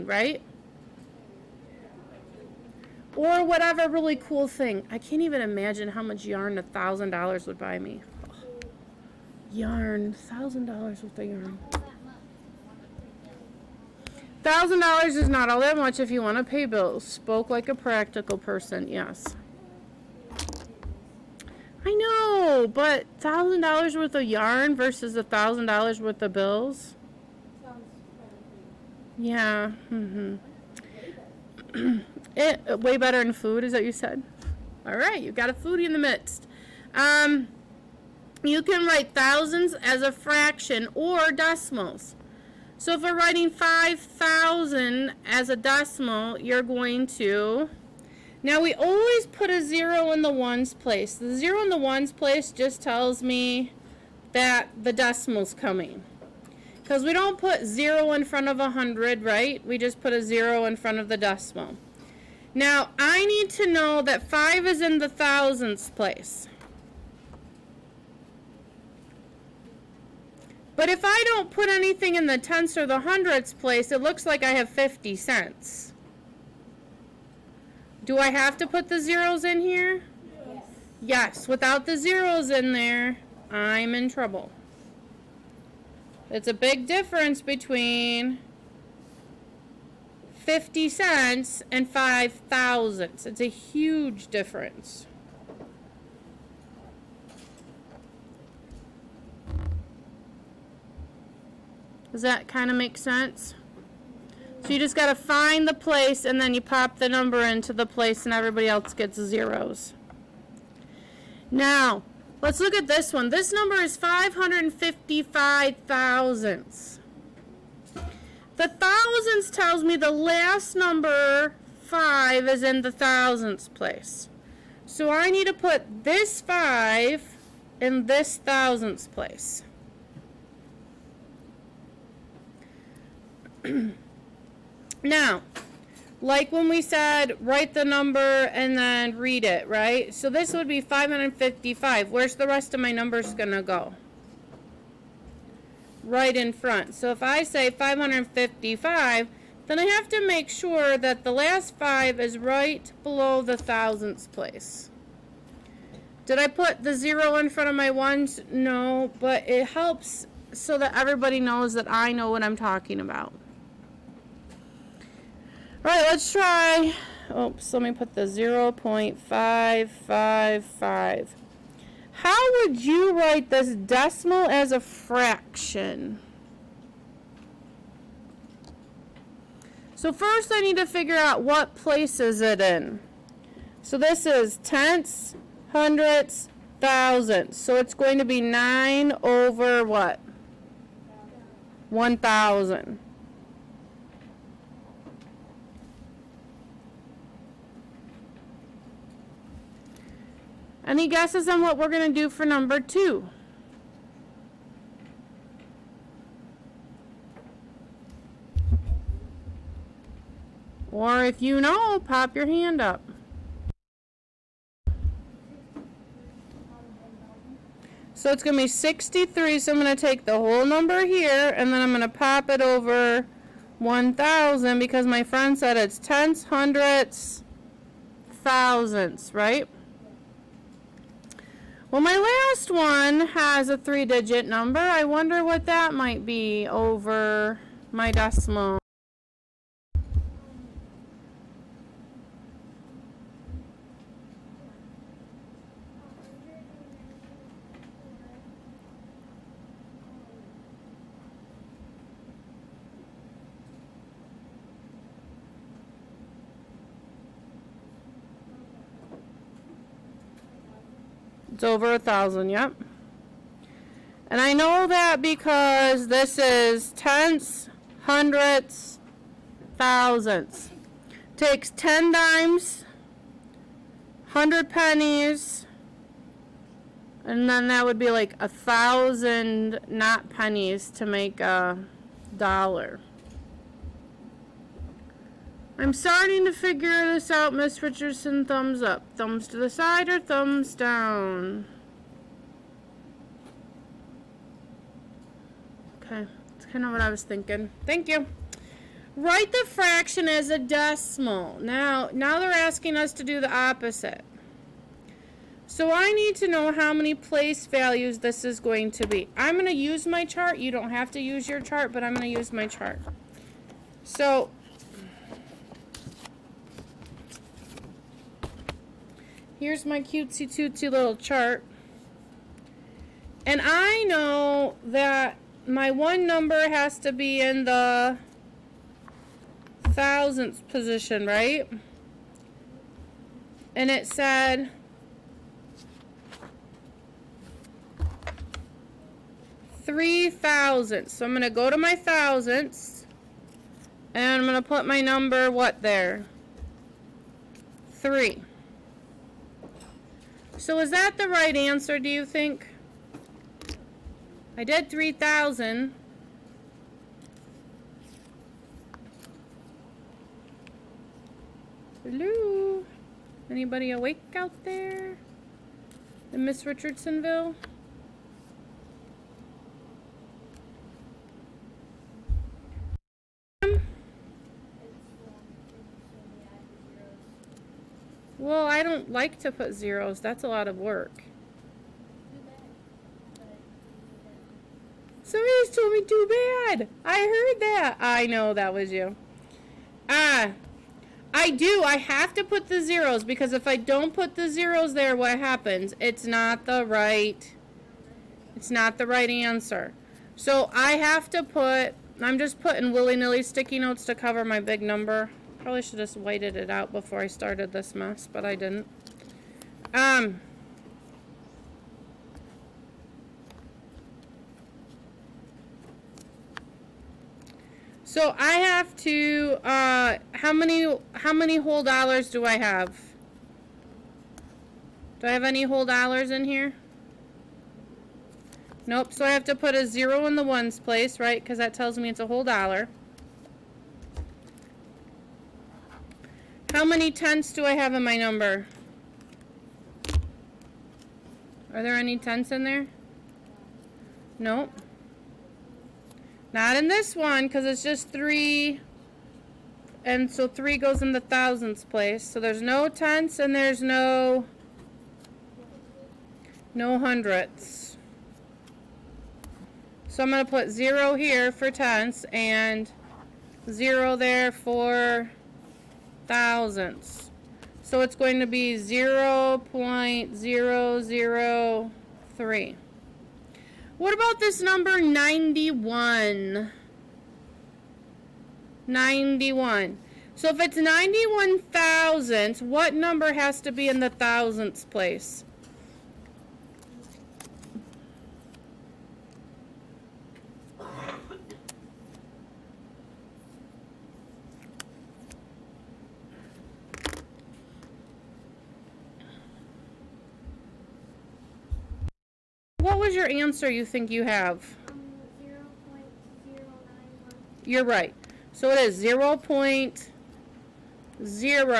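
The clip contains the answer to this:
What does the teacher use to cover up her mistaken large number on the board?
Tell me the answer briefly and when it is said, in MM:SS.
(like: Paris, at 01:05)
sticky notes, at 06:43.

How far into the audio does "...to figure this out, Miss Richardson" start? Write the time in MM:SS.
04:46.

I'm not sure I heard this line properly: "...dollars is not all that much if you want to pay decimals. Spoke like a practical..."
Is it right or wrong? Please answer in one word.
wrong.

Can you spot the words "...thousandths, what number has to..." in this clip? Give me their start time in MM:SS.
08:01.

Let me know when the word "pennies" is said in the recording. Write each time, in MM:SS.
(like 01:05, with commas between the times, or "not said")
04:34, 04:40.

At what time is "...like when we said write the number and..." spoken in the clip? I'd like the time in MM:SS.
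02:16.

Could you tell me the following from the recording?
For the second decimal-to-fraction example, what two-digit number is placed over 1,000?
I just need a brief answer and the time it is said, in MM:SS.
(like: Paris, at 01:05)
63, at 03:38.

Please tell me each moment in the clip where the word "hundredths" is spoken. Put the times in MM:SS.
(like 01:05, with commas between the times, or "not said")
01:13, 03:05, 03:46, 04:28, 07:37.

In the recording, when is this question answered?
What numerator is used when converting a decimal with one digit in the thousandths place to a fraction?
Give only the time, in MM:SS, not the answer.
03:08.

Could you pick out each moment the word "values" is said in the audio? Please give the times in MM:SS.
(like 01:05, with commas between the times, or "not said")
05:07.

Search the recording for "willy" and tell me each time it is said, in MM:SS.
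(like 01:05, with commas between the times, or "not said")
06:42.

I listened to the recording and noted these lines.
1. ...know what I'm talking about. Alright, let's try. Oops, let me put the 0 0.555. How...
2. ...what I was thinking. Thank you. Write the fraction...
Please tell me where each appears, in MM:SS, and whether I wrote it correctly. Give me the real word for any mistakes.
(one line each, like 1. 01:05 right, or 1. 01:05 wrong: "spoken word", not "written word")
1. 02:42 right
2. 04:56 right.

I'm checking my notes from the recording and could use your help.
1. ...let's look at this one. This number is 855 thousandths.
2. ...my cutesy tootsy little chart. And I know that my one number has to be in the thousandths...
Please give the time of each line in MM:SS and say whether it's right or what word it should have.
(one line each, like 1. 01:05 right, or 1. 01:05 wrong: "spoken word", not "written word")
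1. 01:52 wrong: "555", not "855"
2. 05:19 right.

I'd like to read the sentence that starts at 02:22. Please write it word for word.
Where's the rest of my numbers going to go?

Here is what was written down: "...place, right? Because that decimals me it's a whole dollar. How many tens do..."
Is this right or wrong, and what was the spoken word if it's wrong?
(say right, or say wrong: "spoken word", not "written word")
wrong: "tells", not "decimals".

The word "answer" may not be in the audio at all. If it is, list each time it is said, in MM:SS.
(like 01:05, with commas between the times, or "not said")
05:51, 06:39, 08:23.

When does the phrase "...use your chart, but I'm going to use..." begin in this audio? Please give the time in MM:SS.
05:11.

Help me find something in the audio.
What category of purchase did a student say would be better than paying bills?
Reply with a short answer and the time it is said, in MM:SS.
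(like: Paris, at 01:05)
food, at 00:33.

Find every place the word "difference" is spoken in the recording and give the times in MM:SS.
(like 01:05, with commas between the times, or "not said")
01:26, 01:34.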